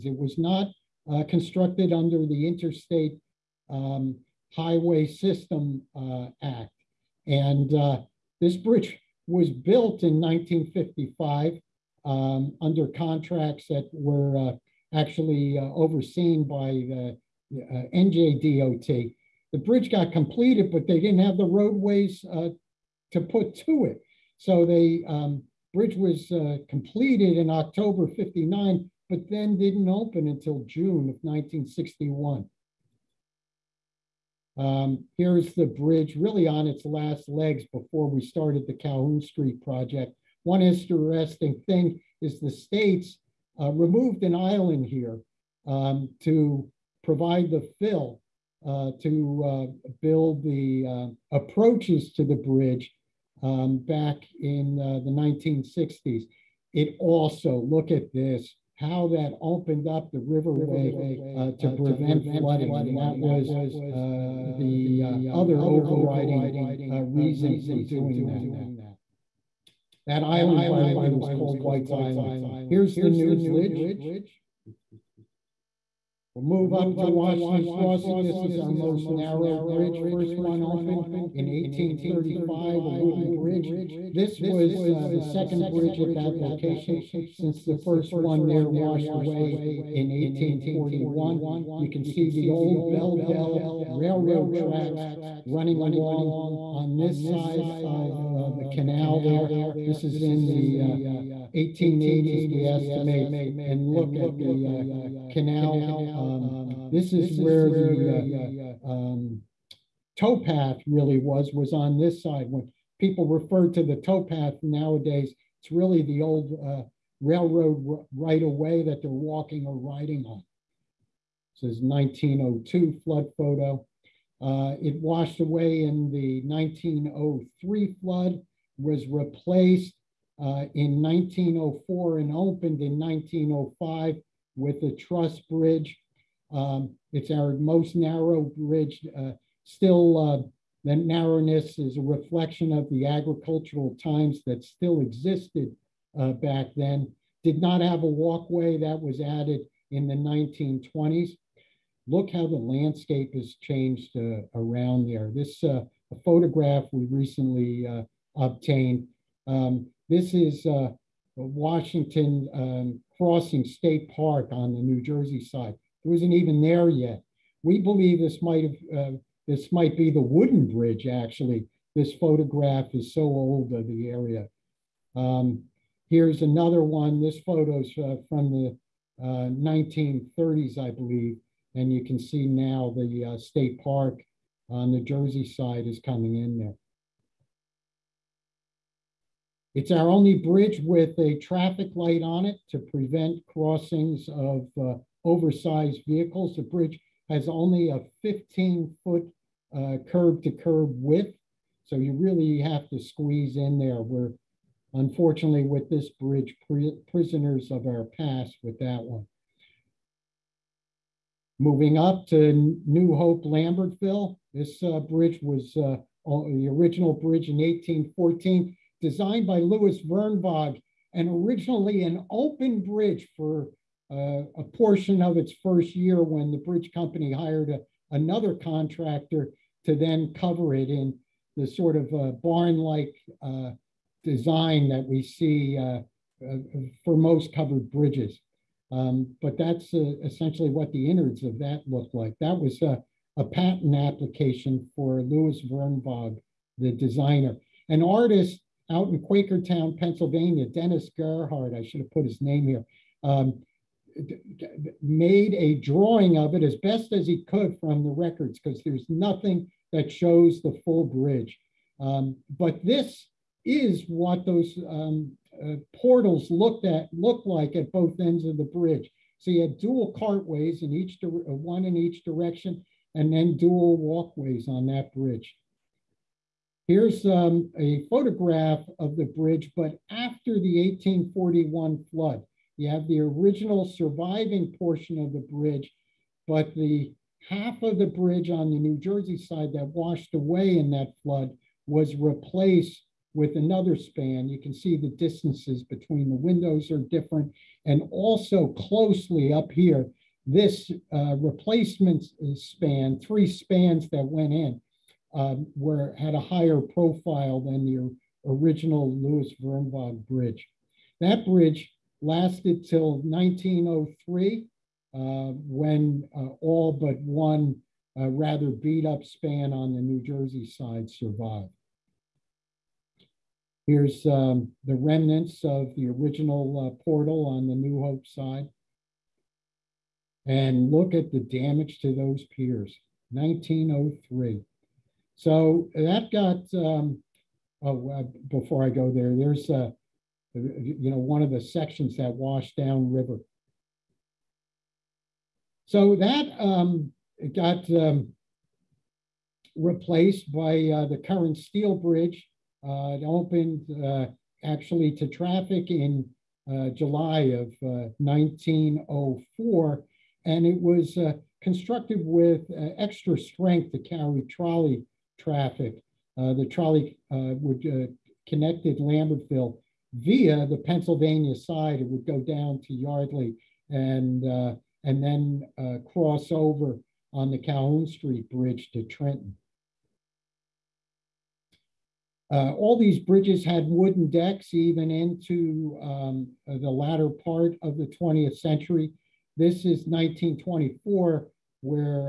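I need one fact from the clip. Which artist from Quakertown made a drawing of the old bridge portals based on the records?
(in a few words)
Dennis Gerhardt.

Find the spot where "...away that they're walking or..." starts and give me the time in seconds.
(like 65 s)
118 s.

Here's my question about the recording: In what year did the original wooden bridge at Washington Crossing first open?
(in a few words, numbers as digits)
1835.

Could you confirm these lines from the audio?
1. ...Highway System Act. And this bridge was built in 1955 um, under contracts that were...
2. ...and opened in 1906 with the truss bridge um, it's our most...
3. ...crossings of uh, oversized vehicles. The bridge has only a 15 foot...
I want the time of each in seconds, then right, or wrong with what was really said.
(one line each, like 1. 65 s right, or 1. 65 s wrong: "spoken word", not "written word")
1. 4 s right
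2. 132 s wrong: "1905", not "1906"
3. 193 s right.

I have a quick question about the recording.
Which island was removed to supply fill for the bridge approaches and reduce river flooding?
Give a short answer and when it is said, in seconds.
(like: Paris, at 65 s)
White's Island, at 71 s.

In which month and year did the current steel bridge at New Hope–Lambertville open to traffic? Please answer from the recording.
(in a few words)
July 1904.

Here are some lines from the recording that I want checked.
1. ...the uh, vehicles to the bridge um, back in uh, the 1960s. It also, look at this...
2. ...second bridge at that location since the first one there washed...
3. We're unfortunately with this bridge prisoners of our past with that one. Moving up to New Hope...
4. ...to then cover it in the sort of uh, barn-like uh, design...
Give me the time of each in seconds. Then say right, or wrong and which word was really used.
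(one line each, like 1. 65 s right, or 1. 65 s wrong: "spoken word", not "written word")
1. 50 s wrong: "approaches", not "vehicles"
2. 85 s right
3. 204 s right
4. 229 s right.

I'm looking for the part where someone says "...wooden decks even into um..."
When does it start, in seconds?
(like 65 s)
383 s.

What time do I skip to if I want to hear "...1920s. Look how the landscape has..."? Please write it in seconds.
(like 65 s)
150 s.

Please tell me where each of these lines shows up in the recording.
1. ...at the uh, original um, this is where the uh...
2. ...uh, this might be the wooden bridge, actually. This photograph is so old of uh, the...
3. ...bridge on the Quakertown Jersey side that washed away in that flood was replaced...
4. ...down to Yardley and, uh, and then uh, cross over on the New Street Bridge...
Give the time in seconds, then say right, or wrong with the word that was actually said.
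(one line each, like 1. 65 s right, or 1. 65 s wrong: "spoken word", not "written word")
1. 104 s wrong: "canal", not "original"
2. 169 s right
3. 288 s wrong: "New", not "Quakertown"
4. 372 s wrong: "Calhoun", not "New".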